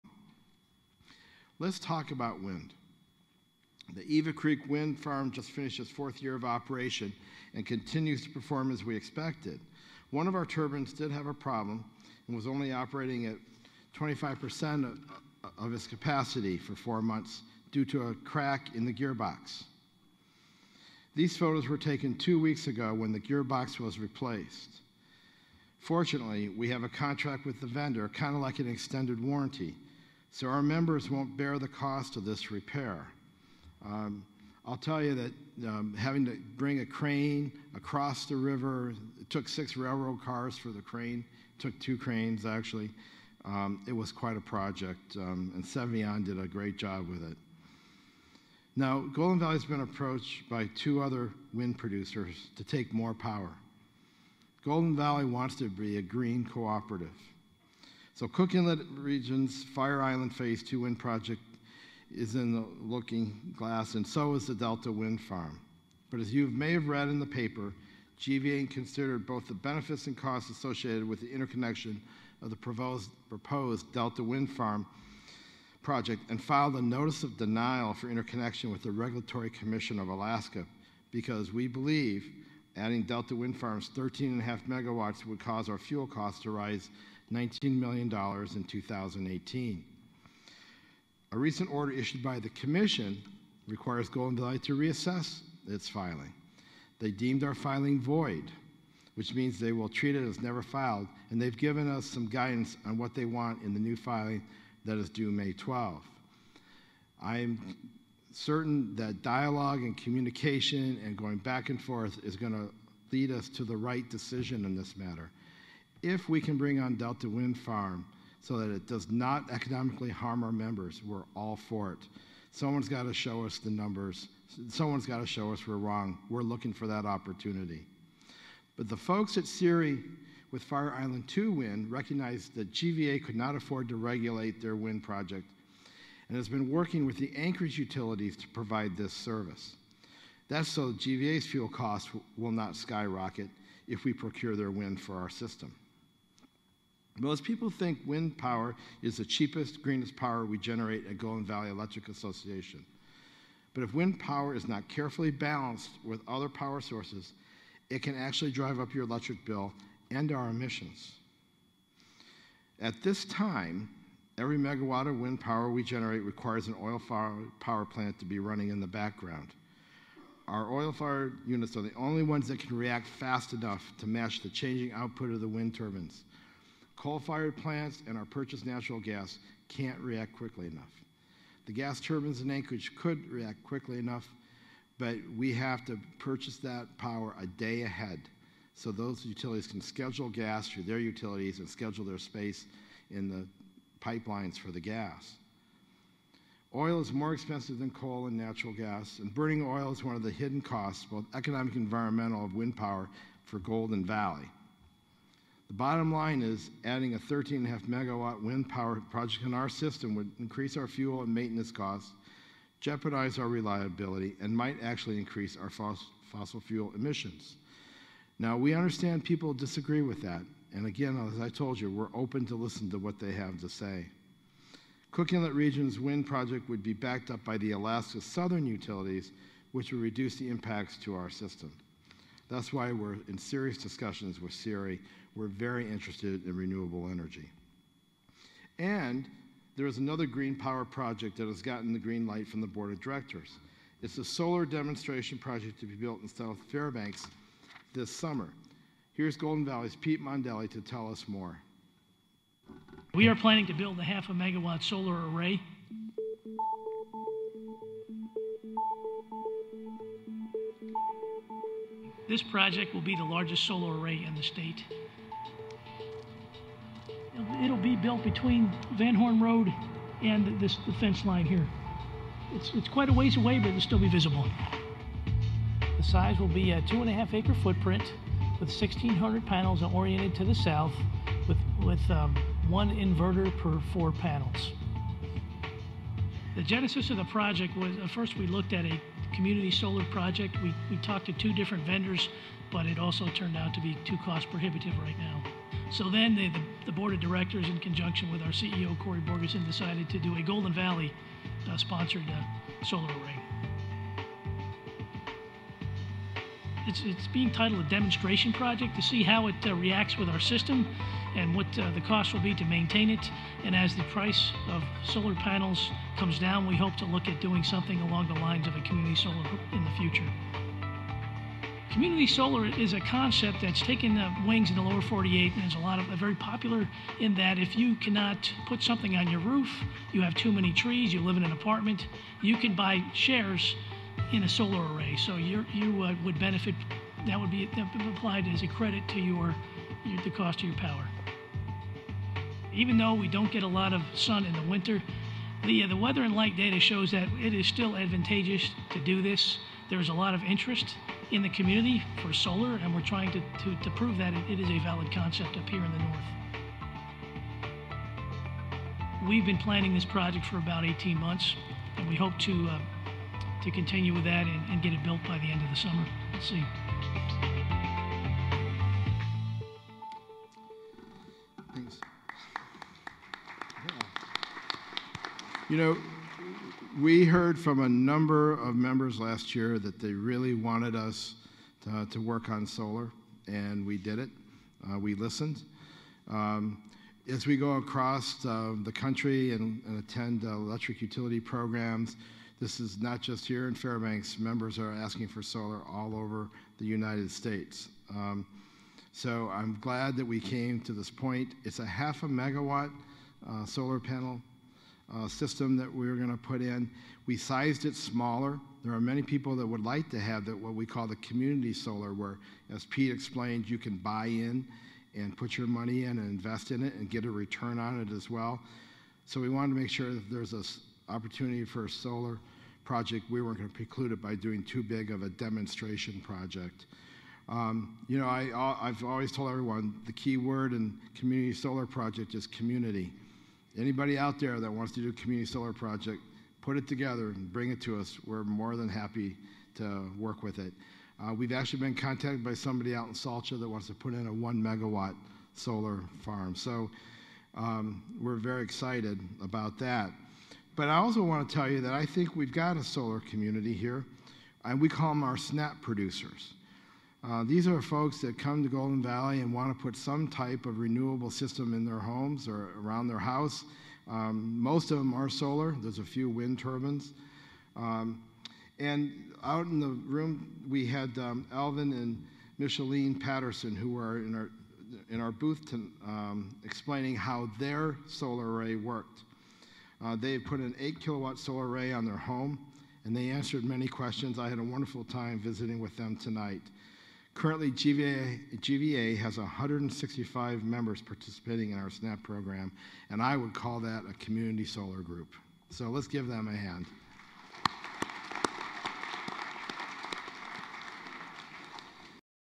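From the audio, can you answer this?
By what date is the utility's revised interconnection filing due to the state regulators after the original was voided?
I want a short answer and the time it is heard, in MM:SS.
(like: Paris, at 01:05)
May 12, at 01:45.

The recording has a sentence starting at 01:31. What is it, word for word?
A recent order issued by the Commission requires Golden Delight to reassess its filing.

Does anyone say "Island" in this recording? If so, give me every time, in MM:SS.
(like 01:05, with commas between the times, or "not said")
01:00, 02:10.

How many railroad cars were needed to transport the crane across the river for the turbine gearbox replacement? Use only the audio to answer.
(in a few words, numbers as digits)
6.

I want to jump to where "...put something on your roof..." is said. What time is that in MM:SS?
05:28.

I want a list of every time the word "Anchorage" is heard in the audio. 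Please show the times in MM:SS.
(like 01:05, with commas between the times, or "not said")
02:17, 03:02.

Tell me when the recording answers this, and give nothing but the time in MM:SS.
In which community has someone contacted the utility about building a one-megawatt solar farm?
07:23.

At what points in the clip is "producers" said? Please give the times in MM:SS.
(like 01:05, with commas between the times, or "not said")
00:51, 07:35.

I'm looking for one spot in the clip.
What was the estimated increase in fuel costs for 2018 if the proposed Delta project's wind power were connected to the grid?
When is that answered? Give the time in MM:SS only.
01:27.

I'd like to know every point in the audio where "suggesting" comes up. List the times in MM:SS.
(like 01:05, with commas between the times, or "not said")
not said.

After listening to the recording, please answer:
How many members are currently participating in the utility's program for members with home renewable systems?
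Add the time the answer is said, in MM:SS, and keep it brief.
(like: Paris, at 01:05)
165, at 08:09.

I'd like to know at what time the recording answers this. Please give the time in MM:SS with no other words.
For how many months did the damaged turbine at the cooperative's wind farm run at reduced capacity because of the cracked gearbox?
00:16.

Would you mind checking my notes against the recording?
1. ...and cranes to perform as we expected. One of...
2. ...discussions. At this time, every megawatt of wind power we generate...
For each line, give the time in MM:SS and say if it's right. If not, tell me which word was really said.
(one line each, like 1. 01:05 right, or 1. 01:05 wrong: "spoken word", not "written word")
1. 00:07 wrong: "continues", not "cranes"
2. 02:40 wrong: "emissions", not "discussions".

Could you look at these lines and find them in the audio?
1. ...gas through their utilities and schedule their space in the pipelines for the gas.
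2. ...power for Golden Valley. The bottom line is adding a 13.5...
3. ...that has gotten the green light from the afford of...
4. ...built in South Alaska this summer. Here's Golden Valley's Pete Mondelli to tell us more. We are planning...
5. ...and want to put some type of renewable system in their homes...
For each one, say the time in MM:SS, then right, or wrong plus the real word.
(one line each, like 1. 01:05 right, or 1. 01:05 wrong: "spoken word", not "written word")
1. 03:10 right
2. 03:22 right
3. 04:01 wrong: "board", not "afford"
4. 04:05 wrong: "Fairbanks", not "Alaska"
5. 07:39 right.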